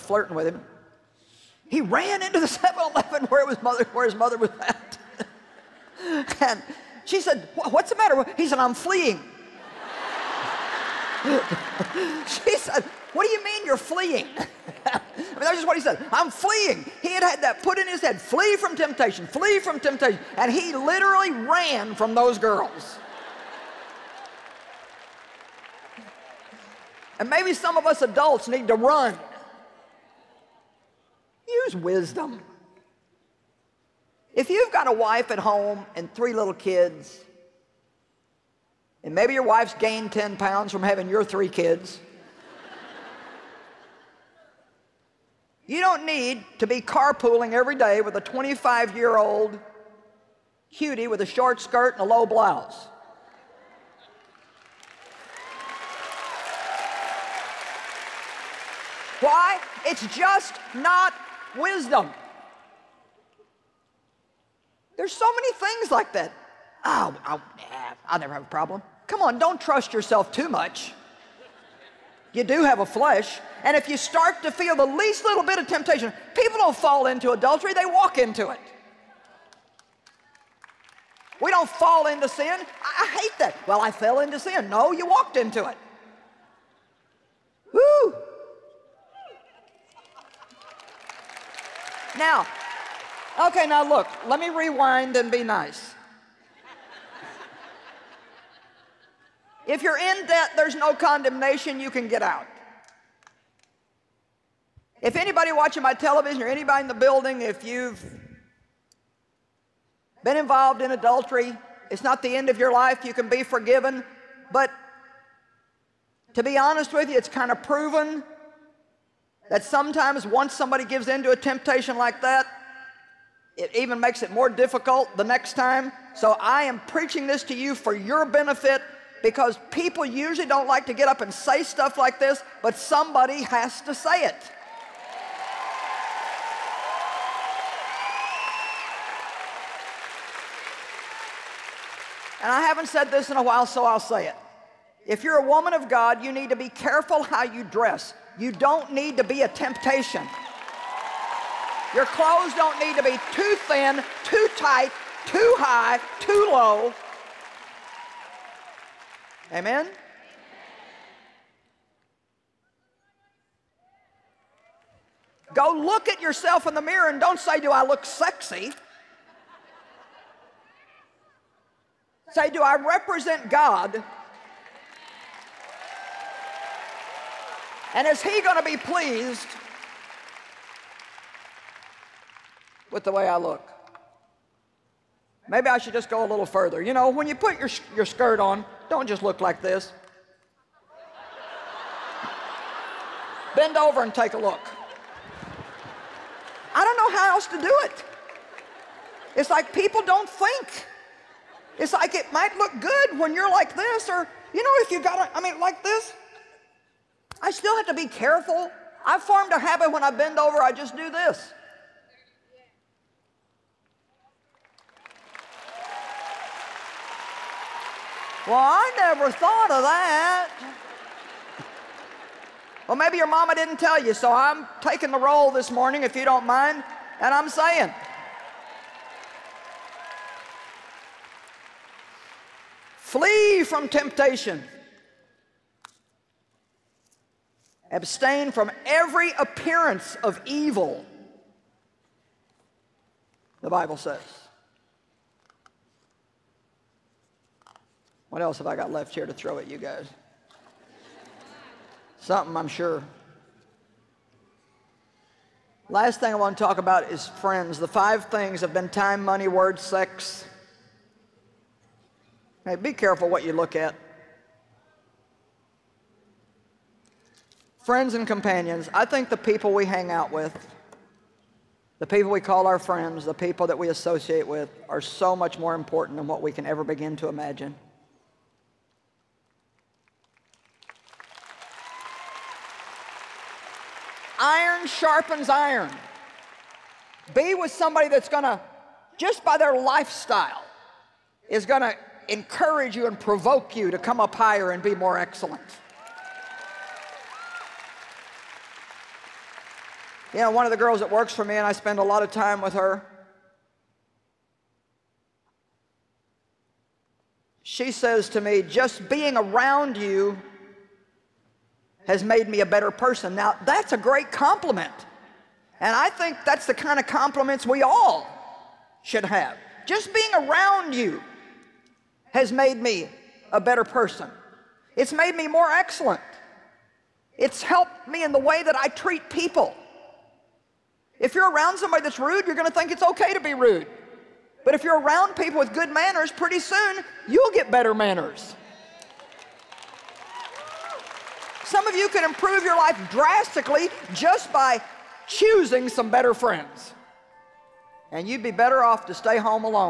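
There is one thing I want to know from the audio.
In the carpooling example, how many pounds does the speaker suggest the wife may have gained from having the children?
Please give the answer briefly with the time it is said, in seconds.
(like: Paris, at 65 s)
10, at 40 s.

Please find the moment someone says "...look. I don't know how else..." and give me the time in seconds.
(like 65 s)
194 s.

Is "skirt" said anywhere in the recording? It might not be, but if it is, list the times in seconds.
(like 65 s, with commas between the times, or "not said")
51 s, 188 s.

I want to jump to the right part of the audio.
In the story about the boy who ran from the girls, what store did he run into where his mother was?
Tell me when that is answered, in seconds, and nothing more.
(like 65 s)
2 s.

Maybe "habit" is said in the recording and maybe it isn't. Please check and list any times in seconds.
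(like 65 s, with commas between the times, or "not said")
209 s.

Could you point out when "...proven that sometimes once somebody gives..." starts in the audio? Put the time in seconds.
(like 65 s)
117 s.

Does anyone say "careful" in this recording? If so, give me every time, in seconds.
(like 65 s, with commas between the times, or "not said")
146 s, 208 s, 262 s.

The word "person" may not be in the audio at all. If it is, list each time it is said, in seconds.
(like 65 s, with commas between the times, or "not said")
312 s, 323 s.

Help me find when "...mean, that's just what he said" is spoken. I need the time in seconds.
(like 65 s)
15 s.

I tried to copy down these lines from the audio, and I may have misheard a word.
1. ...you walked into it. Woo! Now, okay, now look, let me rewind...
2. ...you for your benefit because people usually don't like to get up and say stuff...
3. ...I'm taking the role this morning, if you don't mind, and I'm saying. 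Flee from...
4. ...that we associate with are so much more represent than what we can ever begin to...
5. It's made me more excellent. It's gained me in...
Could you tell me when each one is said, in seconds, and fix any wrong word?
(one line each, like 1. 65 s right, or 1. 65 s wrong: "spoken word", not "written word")
1. 84 s right
2. 127 s right
3. 224 s right
4. 273 s wrong: "important", not "represent"
5. 324 s wrong: "helped", not "gained".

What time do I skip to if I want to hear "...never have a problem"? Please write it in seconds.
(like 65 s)
68 s.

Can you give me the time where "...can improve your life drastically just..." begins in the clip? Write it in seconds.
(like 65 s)
342 s.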